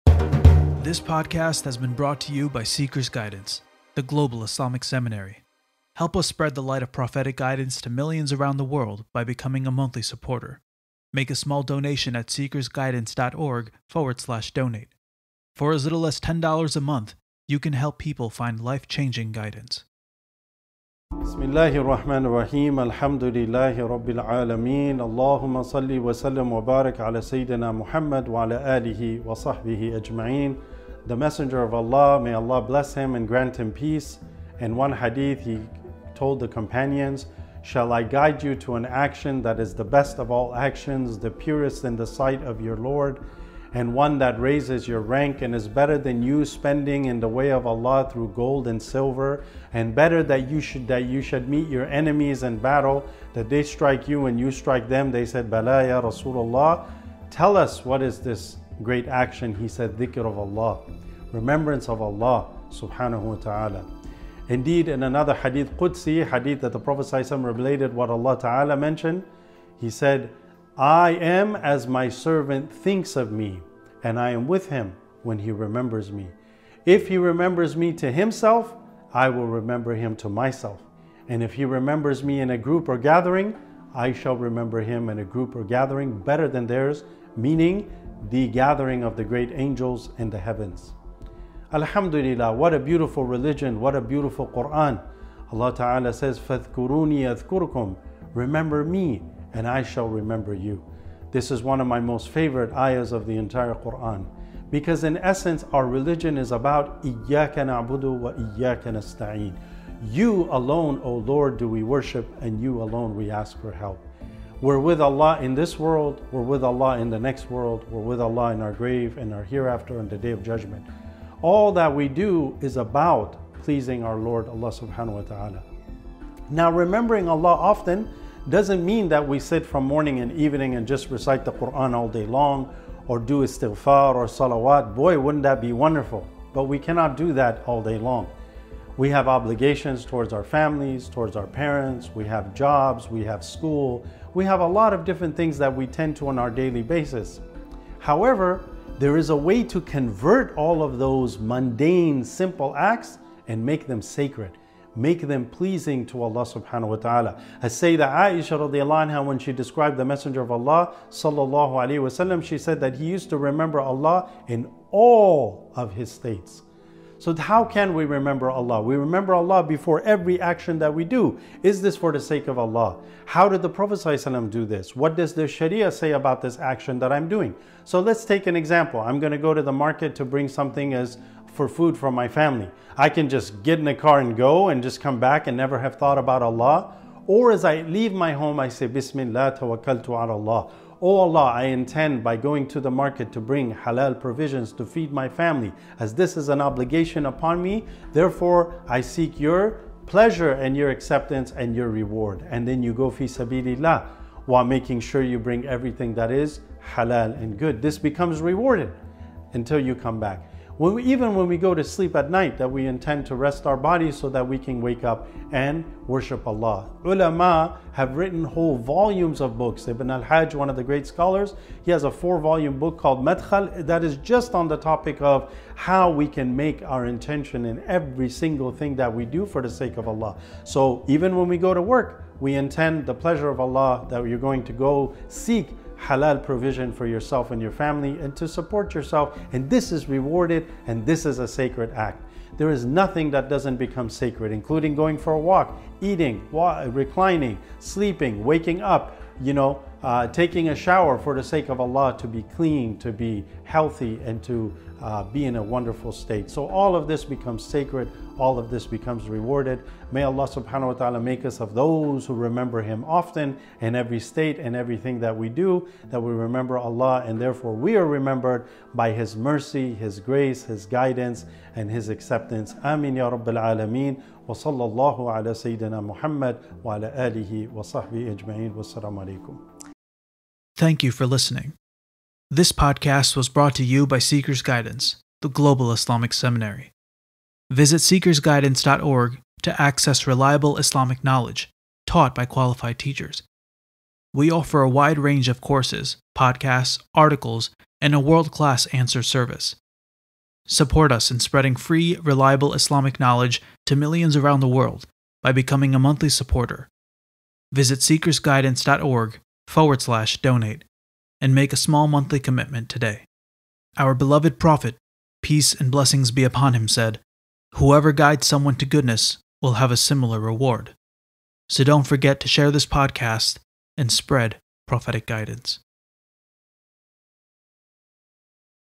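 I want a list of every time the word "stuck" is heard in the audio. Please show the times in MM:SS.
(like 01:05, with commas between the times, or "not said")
not said.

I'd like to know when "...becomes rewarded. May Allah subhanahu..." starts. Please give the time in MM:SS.
04:18.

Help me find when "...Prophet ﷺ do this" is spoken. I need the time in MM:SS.
02:53.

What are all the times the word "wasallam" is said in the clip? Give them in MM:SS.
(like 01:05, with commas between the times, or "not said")
02:42.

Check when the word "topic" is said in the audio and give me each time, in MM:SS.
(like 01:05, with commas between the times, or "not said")
03:44.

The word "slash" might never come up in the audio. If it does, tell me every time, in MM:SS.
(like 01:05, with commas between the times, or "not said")
00:14, 05:10.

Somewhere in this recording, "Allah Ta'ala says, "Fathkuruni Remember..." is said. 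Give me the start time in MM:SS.
01:35.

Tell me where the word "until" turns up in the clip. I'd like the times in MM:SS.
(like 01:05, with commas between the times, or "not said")
03:29.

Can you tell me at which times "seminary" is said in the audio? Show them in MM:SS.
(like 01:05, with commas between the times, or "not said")
00:04, 04:46.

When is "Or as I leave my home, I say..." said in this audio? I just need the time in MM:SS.
03:07.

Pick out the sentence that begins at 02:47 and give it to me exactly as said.
So how can we remember Allah?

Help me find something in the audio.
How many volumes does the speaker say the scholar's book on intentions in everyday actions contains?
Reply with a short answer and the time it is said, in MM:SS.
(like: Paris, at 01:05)
4, at 03:42.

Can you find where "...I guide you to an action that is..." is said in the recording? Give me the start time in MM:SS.
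00:37.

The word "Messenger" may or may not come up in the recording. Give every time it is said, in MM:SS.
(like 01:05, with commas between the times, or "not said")
00:31, 02:40.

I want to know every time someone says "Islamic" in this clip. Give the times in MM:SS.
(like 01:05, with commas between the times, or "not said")
00:04, 04:45, 04:50, 05:02.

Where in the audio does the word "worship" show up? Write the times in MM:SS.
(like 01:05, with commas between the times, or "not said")
01:51, 03:36.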